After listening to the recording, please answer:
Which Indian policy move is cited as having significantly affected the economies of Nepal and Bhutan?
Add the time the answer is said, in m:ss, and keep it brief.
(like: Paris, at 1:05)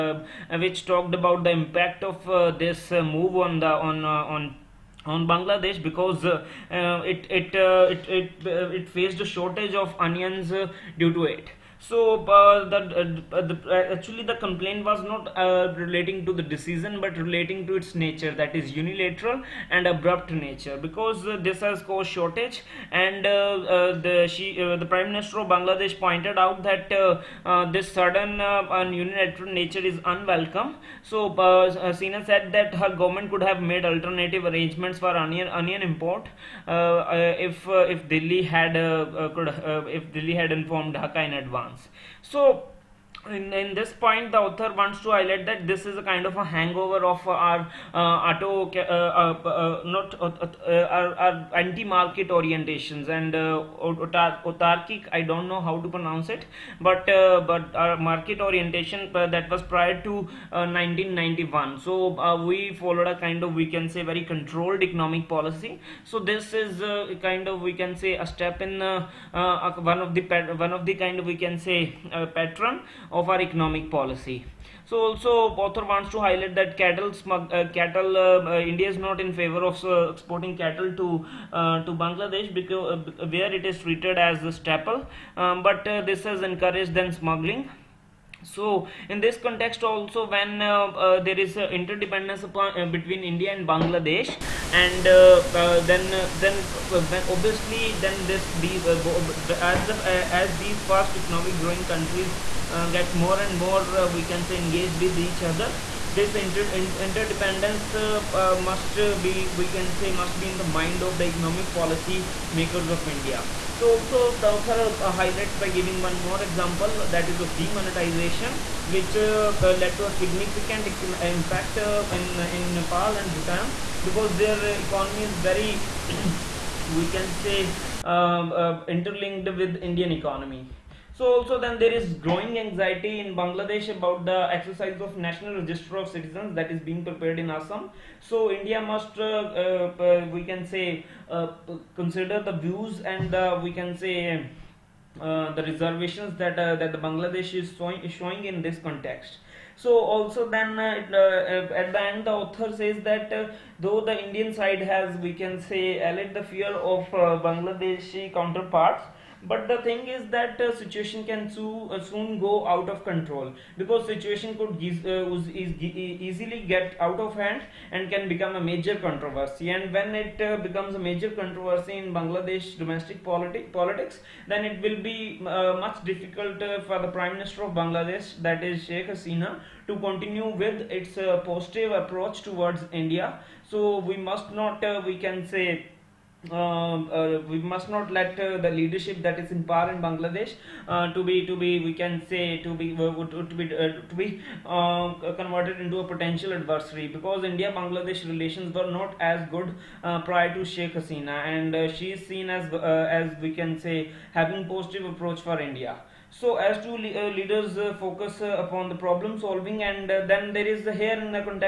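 Demonetization, at 1:57.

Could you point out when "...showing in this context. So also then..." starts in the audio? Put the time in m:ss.
2:28.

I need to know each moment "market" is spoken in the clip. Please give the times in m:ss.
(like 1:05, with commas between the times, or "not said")
0:51, 0:57.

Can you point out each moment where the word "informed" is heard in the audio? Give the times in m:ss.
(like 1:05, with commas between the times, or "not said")
0:40.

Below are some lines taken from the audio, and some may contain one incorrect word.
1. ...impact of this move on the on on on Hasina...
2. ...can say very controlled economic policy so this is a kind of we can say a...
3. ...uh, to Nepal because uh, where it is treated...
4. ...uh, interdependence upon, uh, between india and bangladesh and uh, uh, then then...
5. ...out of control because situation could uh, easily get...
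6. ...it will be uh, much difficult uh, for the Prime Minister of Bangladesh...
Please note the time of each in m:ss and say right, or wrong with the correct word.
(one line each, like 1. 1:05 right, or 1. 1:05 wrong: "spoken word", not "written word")
1. 0:01 wrong: "Bangladesh", not "Hasina"
2. 1:03 right
3. 1:21 wrong: "Bangladesh", not "Nepal"
4. 1:31 right
5. 2:42 right
6. 2:54 right.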